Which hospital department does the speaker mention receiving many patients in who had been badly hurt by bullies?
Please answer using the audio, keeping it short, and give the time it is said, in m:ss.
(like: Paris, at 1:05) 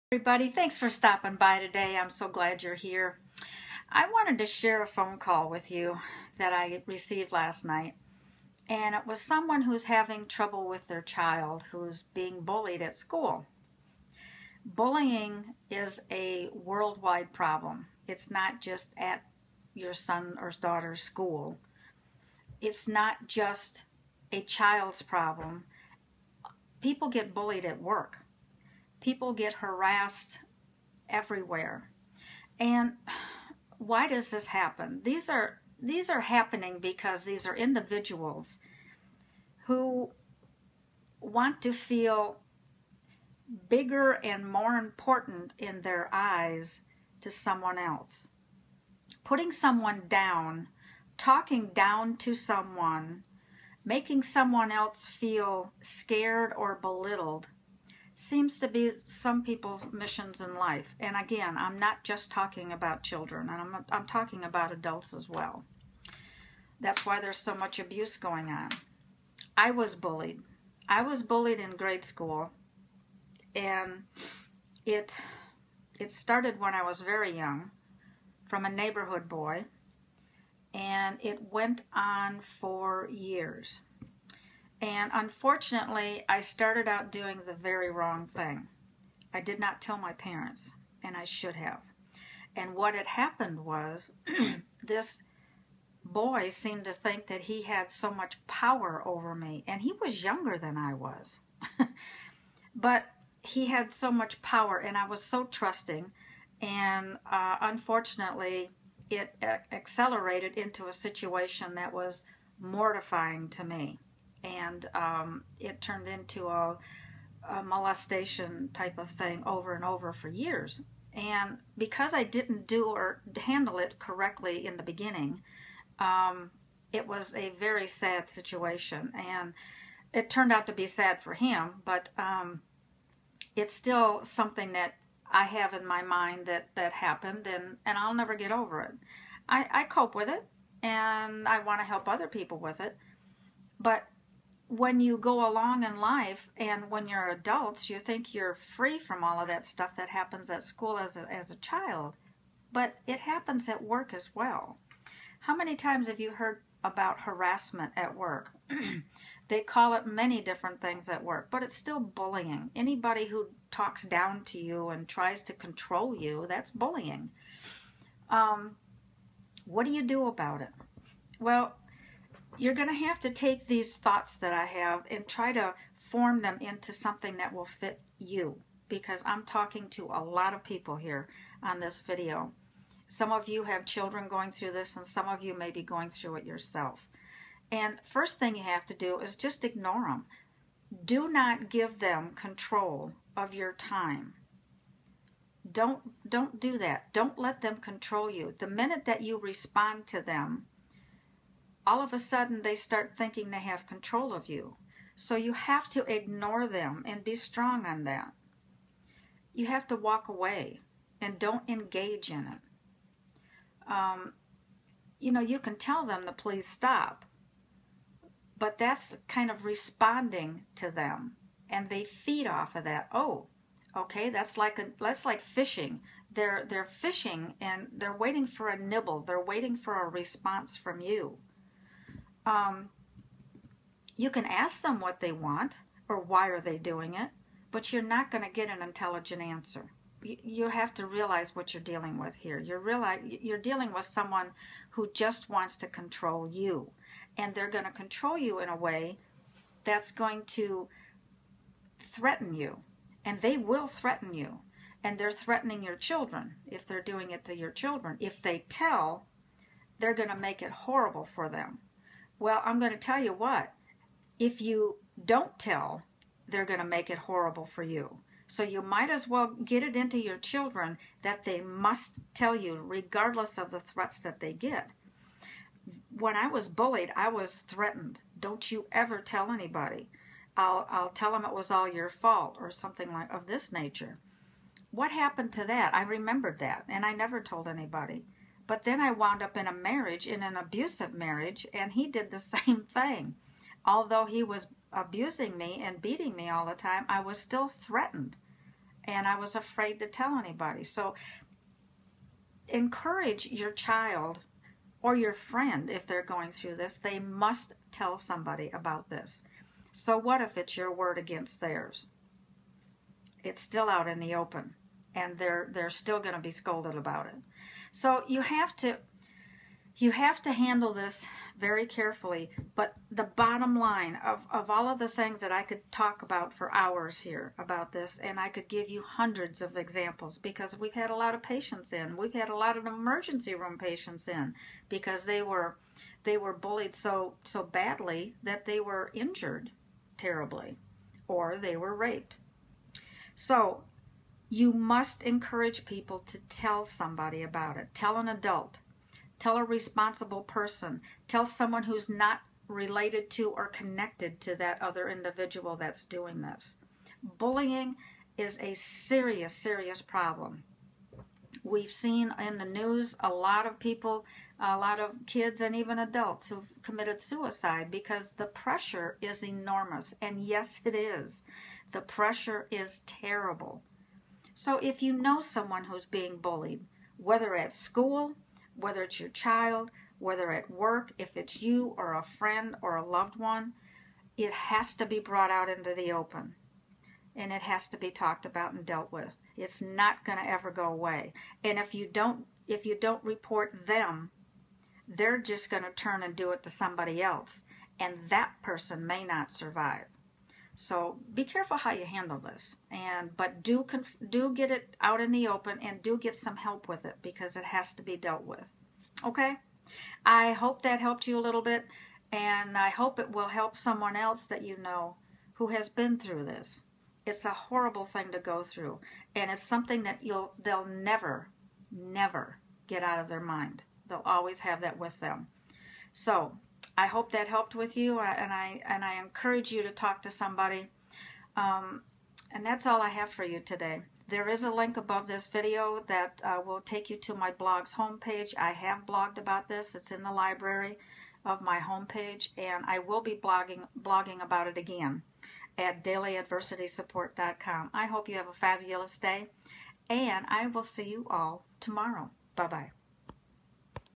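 Emergency room, at 5:32.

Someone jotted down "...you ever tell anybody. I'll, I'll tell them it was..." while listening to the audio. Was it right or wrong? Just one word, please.
right.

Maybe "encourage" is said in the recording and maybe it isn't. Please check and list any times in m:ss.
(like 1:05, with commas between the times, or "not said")
5:02, 5:45, 7:09.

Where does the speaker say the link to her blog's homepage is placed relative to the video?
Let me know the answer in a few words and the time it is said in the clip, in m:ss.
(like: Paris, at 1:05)
Above, at 7:14.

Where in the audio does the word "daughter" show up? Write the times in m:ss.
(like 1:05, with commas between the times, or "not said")
0:20.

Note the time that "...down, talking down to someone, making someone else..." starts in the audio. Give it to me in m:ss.
0:50.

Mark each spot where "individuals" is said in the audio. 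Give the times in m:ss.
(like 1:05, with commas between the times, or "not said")
0:37, 5:55.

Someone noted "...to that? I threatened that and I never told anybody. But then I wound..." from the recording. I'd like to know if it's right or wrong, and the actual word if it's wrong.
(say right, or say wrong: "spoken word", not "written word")
wrong: "remembered", not "threatened".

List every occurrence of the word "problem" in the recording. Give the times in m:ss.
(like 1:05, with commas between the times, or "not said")
0:17, 0:25, 6:00.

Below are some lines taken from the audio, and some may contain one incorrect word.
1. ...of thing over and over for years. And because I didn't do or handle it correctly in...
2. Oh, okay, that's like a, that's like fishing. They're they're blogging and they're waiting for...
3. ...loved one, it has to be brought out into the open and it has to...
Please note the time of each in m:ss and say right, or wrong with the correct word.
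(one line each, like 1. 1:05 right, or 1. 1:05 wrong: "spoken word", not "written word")
1. 1:58 right
2. 3:43 wrong: "fishing", not "blogging"
3. 6:23 right.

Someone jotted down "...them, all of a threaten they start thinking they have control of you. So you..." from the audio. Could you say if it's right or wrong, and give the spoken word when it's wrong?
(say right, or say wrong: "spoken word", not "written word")
wrong: "sudden", not "threaten".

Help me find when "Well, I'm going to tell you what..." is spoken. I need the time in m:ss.
4:22.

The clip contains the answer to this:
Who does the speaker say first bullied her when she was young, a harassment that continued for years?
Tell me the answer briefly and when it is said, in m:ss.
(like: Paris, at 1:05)
A neighborhood boy, at 1:18.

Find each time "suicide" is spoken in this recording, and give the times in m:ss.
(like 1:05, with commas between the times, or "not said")
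6:07.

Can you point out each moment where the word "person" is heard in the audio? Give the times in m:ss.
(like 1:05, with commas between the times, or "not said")
5:50, 6:38.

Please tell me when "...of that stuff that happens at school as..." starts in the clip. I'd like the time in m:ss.
2:29.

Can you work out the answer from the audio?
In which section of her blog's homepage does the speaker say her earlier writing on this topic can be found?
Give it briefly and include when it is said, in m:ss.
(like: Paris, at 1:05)
The library, at 7:20.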